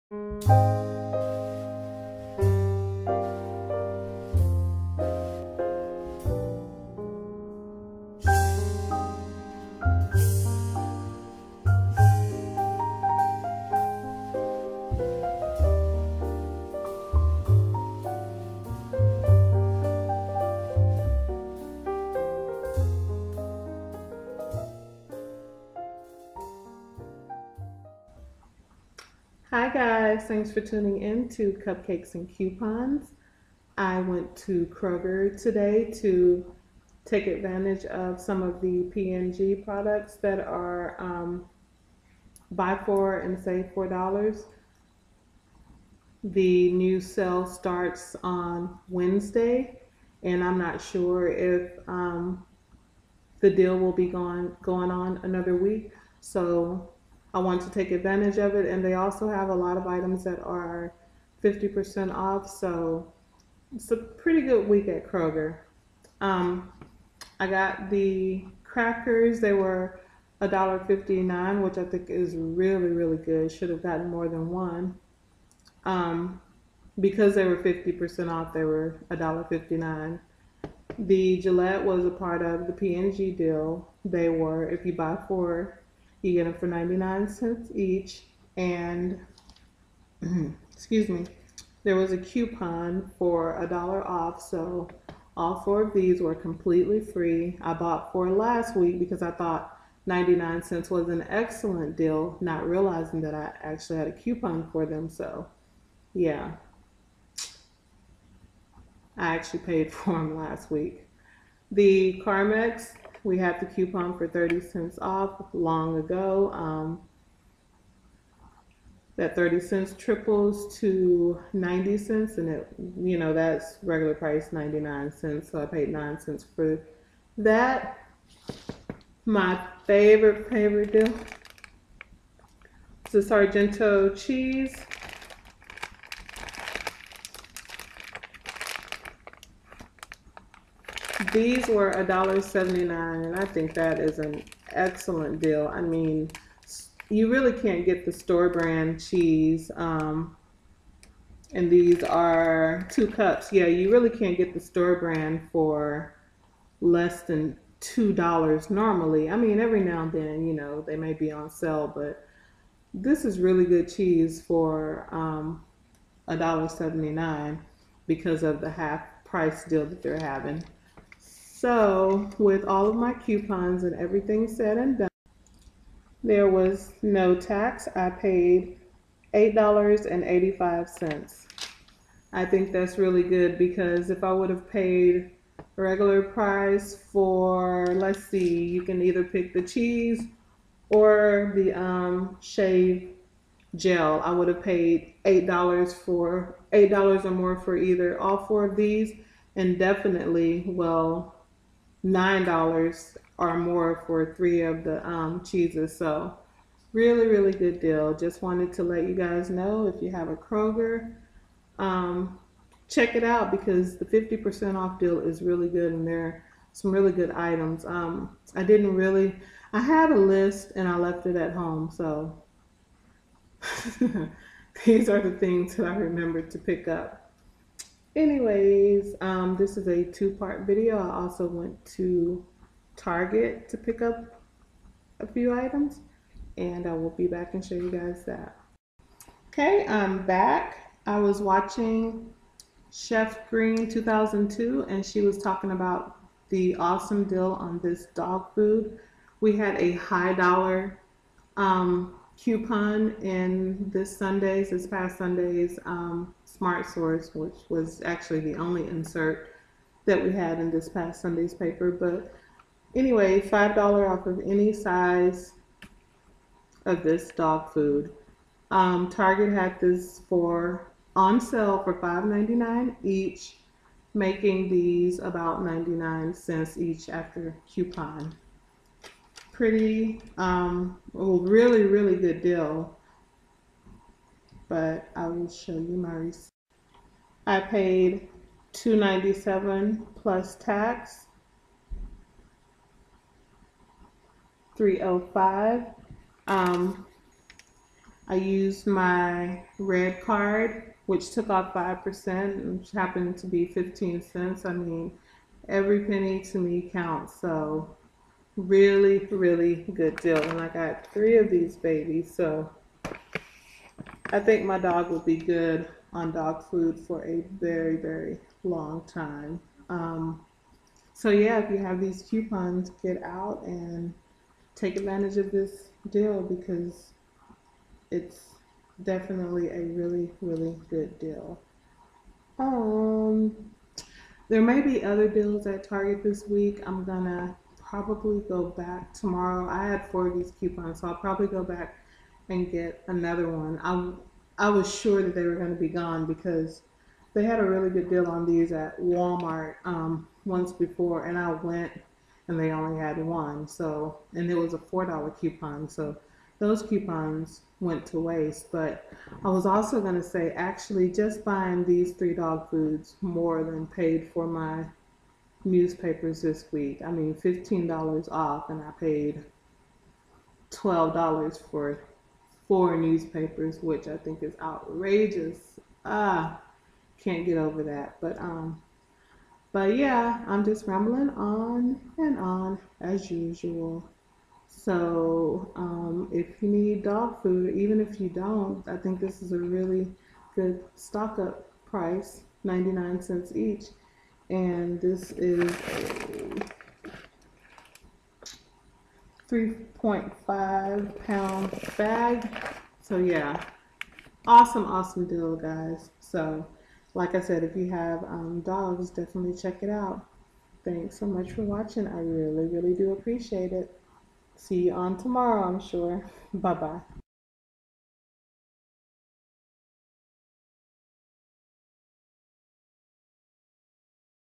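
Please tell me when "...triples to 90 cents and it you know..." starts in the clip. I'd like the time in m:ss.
1:59.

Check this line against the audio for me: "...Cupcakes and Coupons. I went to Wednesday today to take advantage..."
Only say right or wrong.
wrong.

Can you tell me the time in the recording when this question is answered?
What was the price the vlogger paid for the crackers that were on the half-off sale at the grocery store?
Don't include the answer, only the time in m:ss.
1:09.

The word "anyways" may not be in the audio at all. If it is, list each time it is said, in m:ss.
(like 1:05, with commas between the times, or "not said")
3:48, 4:22.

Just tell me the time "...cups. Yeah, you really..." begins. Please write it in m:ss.
2:33.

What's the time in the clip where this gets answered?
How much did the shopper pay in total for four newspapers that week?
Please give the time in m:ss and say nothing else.
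6:08.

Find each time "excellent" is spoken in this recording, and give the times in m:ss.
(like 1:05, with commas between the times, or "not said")
1:41, 2:24.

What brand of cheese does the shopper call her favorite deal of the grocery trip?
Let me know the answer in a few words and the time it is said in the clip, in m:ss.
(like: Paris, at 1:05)
Sargento, at 2:13.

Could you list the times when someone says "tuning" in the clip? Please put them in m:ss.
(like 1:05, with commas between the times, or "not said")
0:30.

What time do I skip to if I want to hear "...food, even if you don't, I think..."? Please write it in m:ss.
6:27.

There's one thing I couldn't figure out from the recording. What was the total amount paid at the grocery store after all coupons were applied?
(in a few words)
$8.85.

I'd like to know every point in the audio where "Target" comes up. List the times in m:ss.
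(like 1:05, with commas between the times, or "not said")
3:52, 4:29, 5:35.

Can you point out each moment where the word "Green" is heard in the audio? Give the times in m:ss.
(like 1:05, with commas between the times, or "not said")
4:03.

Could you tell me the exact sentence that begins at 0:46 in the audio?
The new sale starts on Wednesday, and I'm not sure if um, the deal will be going going on another week.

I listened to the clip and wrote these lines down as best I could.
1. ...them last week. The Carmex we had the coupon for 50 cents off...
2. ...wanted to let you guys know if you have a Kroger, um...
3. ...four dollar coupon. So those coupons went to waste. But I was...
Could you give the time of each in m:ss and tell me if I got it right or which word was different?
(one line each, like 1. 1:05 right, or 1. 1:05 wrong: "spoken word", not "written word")
1. 1:50 wrong: "30", not "50"
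2. 3:28 right
3. 5:54 right.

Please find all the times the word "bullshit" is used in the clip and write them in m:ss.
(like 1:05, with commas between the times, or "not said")
not said.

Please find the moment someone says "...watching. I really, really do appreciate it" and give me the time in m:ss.
6:51.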